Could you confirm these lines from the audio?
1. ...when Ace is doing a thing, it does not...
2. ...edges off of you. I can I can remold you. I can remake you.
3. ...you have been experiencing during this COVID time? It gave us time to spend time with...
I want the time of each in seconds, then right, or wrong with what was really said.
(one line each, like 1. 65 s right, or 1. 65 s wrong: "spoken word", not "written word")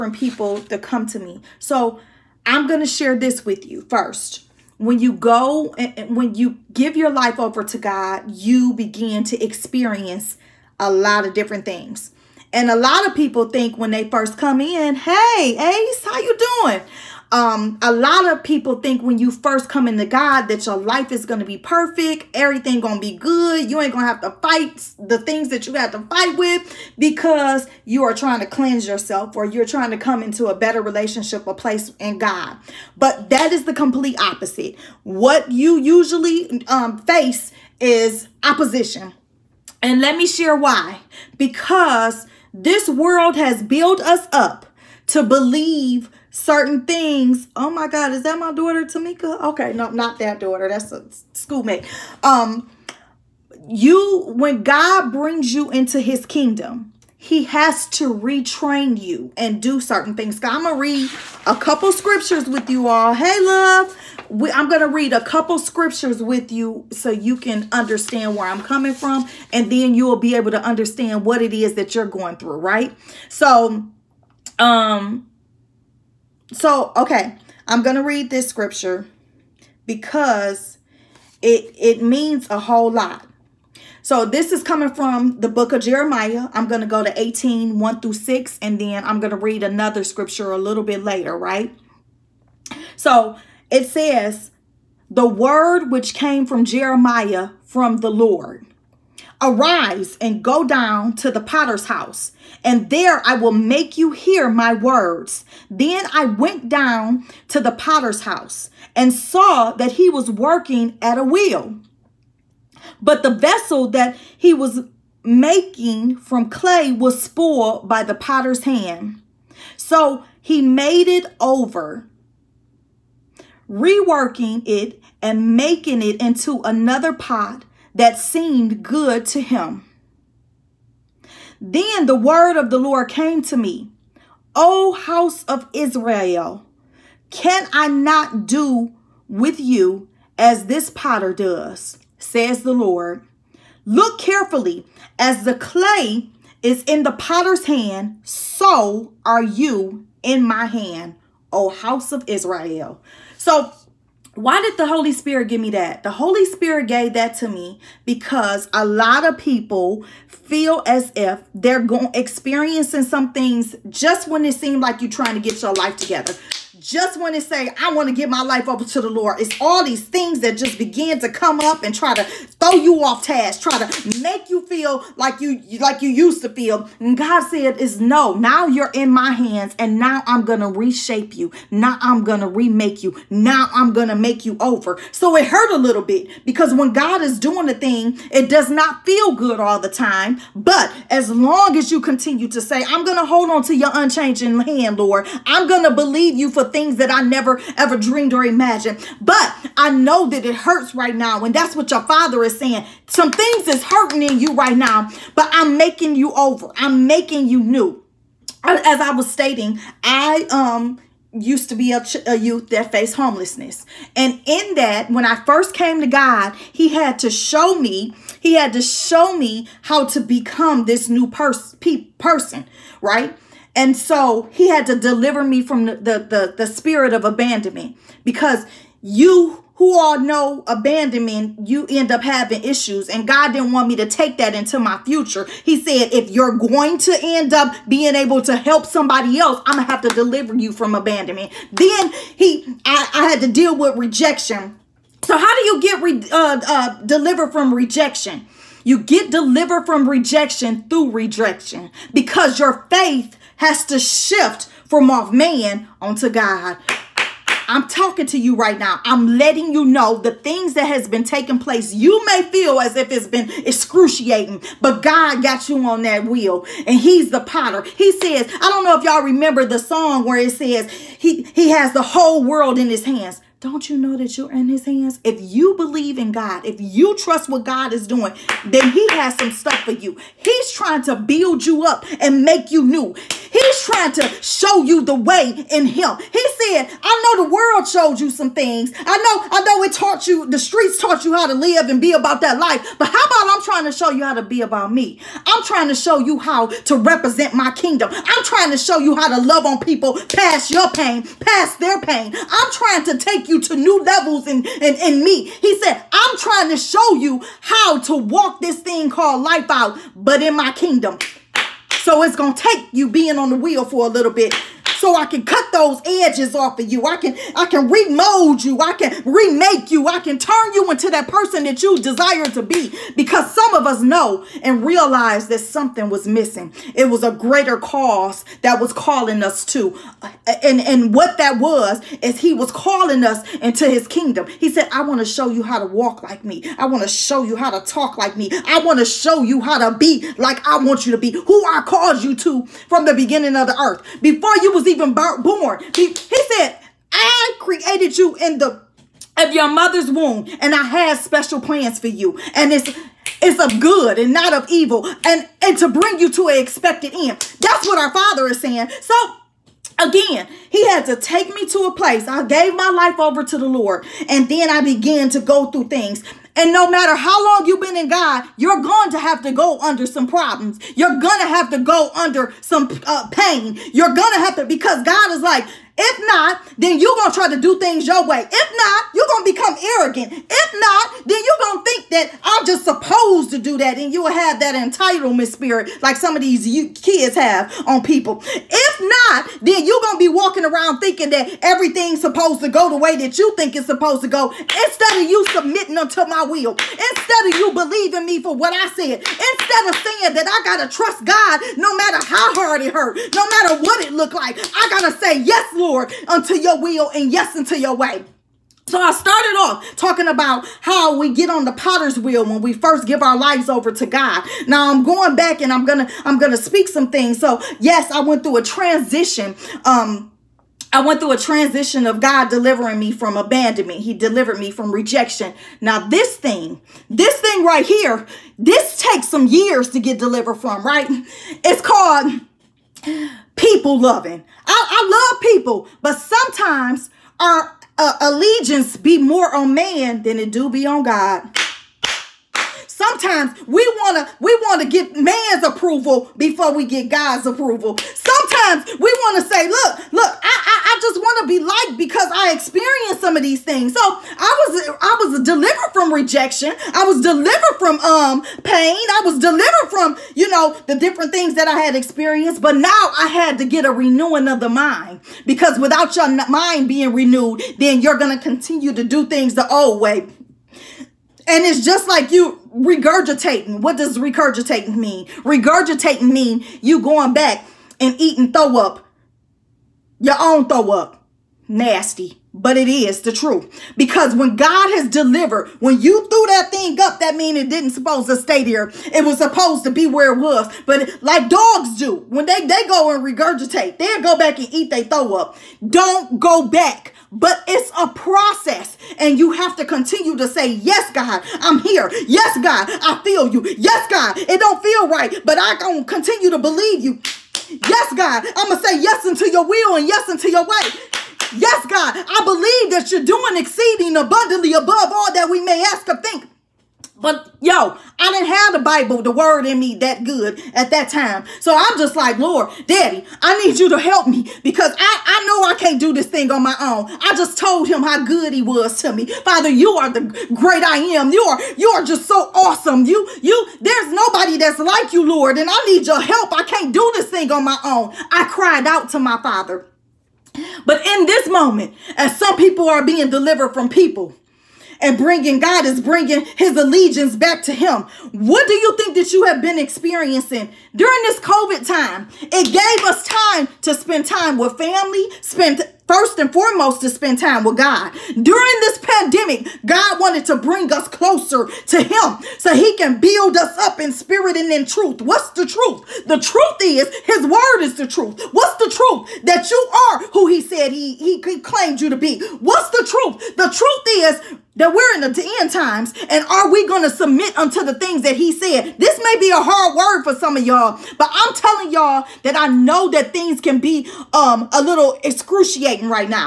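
1. 186 s wrong: "God", not "Ace"
2. 316 s right
3. 549 s right.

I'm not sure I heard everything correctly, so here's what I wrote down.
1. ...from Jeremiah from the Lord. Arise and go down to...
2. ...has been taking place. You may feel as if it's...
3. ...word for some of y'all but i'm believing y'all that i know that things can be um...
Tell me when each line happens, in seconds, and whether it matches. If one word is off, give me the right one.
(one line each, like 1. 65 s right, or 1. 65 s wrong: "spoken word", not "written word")
1. 96 s right
2. 260 s right
3. 579 s wrong: "telling", not "believing".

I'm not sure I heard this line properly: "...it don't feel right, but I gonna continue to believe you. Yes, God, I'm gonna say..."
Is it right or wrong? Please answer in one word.
right.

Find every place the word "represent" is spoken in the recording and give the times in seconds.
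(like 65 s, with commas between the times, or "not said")
296 s.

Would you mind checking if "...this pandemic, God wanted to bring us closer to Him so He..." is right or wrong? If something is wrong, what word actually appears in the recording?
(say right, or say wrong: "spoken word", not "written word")
right.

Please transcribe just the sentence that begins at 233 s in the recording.
And God didn't want me to take that into my future.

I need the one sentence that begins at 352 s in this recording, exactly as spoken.
And it's it's of good and not of evil and and to bring you to an expected end.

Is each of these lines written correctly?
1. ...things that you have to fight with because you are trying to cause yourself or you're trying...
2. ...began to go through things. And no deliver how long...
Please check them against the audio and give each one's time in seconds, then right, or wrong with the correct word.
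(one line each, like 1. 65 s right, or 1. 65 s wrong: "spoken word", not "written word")
1. 25 s wrong: "cleanse", not "cause"
2. 364 s wrong: "matter", not "deliver".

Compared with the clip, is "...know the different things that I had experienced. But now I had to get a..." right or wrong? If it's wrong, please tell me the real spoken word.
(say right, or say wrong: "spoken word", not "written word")
right.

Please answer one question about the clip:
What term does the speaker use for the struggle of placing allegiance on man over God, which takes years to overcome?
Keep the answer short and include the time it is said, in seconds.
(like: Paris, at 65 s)
People loving, at 433 s.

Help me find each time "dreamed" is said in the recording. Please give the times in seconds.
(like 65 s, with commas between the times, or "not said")
197 s.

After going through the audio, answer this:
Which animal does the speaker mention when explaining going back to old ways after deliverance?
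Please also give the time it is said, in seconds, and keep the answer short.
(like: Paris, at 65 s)
Dogs, at 491 s.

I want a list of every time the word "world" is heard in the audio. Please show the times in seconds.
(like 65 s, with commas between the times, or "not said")
42 s, 272 s, 287 s.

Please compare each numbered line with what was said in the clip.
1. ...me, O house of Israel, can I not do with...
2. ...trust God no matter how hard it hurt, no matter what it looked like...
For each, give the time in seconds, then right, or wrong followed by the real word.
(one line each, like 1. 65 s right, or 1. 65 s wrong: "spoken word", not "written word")
1. 133 s right
2. 400 s right.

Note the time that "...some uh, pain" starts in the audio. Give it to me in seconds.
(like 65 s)
372 s.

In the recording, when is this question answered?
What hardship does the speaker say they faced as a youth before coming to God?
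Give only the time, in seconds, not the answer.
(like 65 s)
213 s.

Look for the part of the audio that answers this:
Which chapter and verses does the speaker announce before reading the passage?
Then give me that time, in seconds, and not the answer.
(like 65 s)
87 s.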